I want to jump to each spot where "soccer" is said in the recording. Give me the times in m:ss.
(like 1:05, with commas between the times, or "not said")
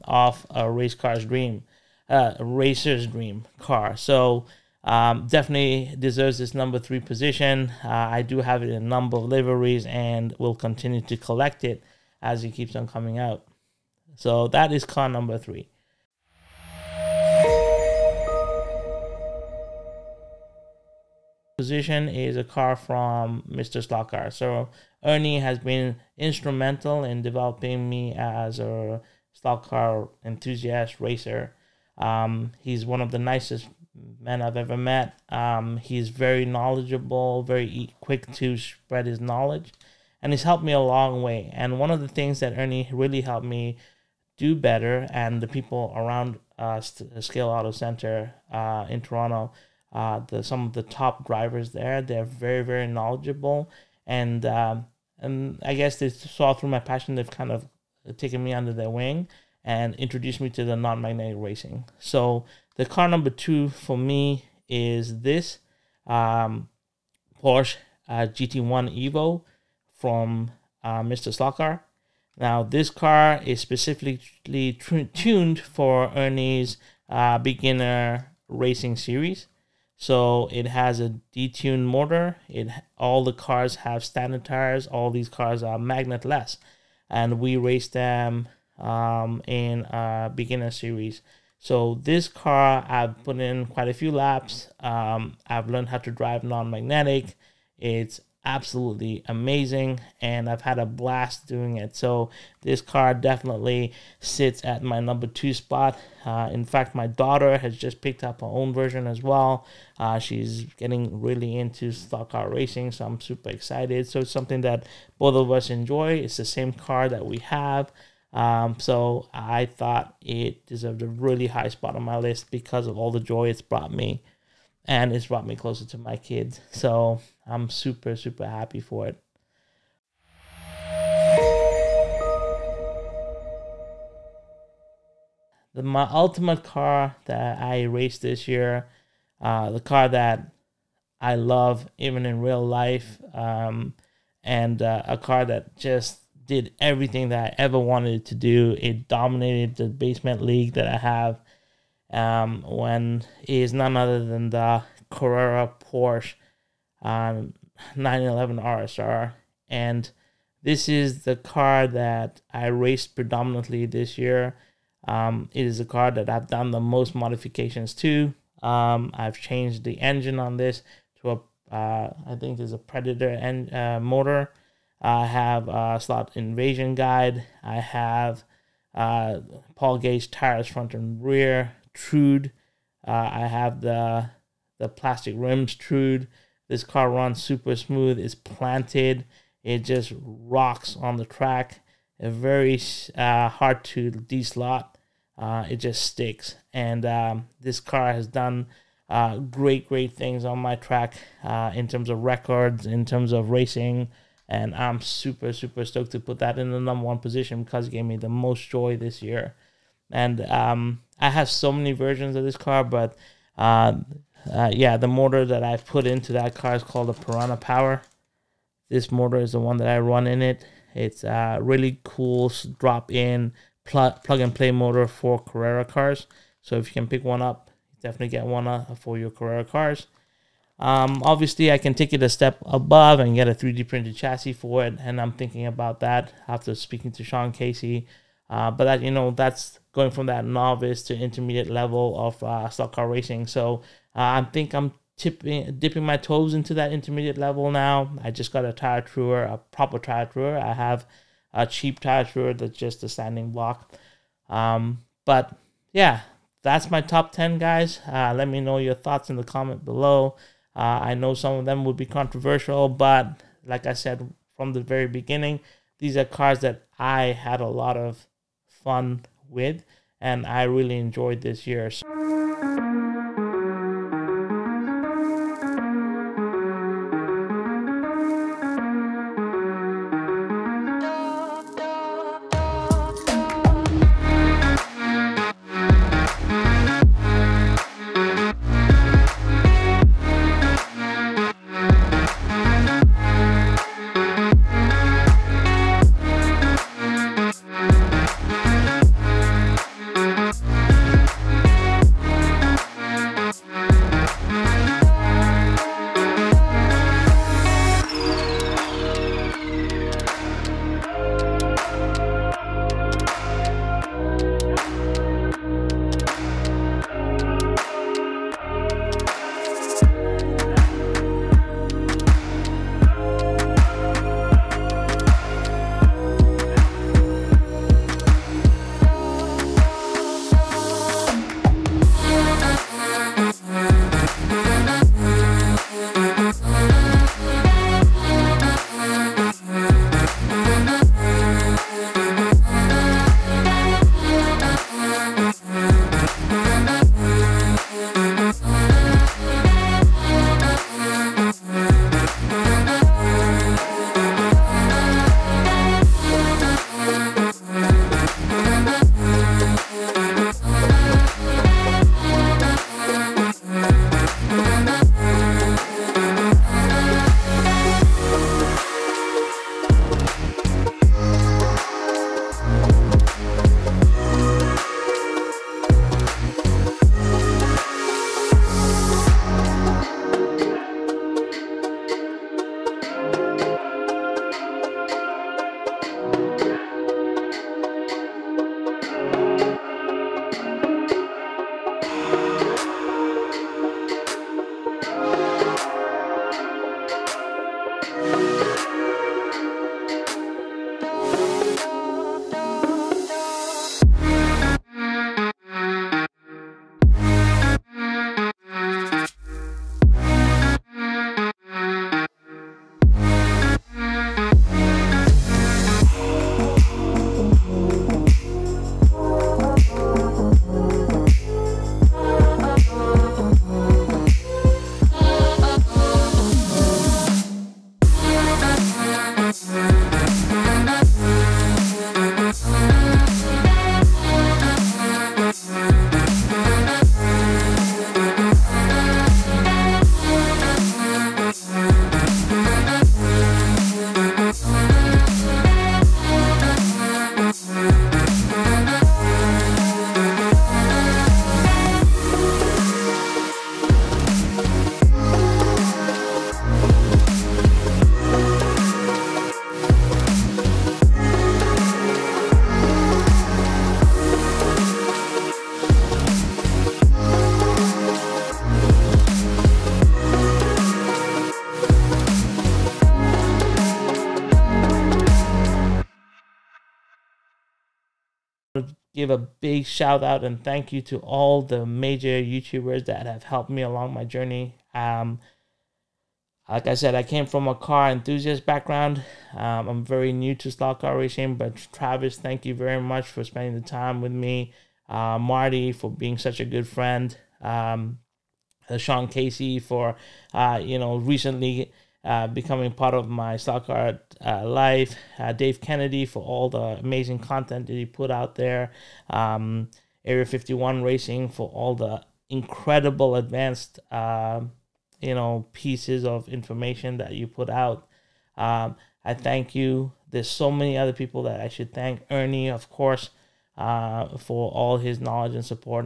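8:23.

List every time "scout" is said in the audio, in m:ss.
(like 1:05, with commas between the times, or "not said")
not said.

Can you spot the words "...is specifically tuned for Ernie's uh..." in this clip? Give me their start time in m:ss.
1:13.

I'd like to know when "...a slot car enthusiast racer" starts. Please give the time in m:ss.
0:28.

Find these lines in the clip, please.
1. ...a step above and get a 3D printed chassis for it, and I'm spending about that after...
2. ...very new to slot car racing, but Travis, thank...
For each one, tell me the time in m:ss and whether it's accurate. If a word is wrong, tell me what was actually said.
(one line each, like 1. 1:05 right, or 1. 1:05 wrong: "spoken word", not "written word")
1. 3:52 wrong: "thinking", not "spending"
2. 8:10 right.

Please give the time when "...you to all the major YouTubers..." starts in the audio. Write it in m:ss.
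8:00.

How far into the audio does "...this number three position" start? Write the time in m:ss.
0:06.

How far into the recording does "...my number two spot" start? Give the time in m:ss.
1:44.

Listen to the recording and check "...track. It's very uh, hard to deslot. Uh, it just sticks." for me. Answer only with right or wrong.
right.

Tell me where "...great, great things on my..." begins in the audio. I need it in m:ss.
3:19.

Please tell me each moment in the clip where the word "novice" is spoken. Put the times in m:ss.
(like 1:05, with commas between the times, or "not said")
4:00.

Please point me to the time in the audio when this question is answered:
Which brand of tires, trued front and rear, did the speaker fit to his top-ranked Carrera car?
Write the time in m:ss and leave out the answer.
2:59.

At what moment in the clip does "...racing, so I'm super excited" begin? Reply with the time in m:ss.
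1:52.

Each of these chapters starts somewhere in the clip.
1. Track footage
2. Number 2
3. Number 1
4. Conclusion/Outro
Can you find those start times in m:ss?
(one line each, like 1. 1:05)
1. 4:34
2. 0:17
3. 2:11
4. 7:59.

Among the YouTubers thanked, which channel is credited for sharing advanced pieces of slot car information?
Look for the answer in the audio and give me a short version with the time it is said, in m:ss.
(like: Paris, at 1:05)
Area 51 Racing, at 8:30.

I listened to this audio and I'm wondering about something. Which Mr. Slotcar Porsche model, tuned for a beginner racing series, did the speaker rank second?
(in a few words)
GT1 Evo.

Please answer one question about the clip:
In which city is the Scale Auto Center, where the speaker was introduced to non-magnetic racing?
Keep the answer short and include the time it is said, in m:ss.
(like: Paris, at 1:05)
Toronto, at 0:49.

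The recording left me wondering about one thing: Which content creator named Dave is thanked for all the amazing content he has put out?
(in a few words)
Dave Kennedy.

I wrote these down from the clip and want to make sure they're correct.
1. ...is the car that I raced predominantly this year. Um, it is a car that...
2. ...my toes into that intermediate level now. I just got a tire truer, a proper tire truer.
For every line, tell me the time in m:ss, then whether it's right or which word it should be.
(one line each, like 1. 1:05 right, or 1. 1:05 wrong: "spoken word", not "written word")
1. 2:40 right
2. 4:06 right.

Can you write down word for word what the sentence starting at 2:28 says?
It dominated the basement league that I have.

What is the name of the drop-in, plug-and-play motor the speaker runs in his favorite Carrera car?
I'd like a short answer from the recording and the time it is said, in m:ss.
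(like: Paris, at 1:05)
Piranha Power, at 3:37.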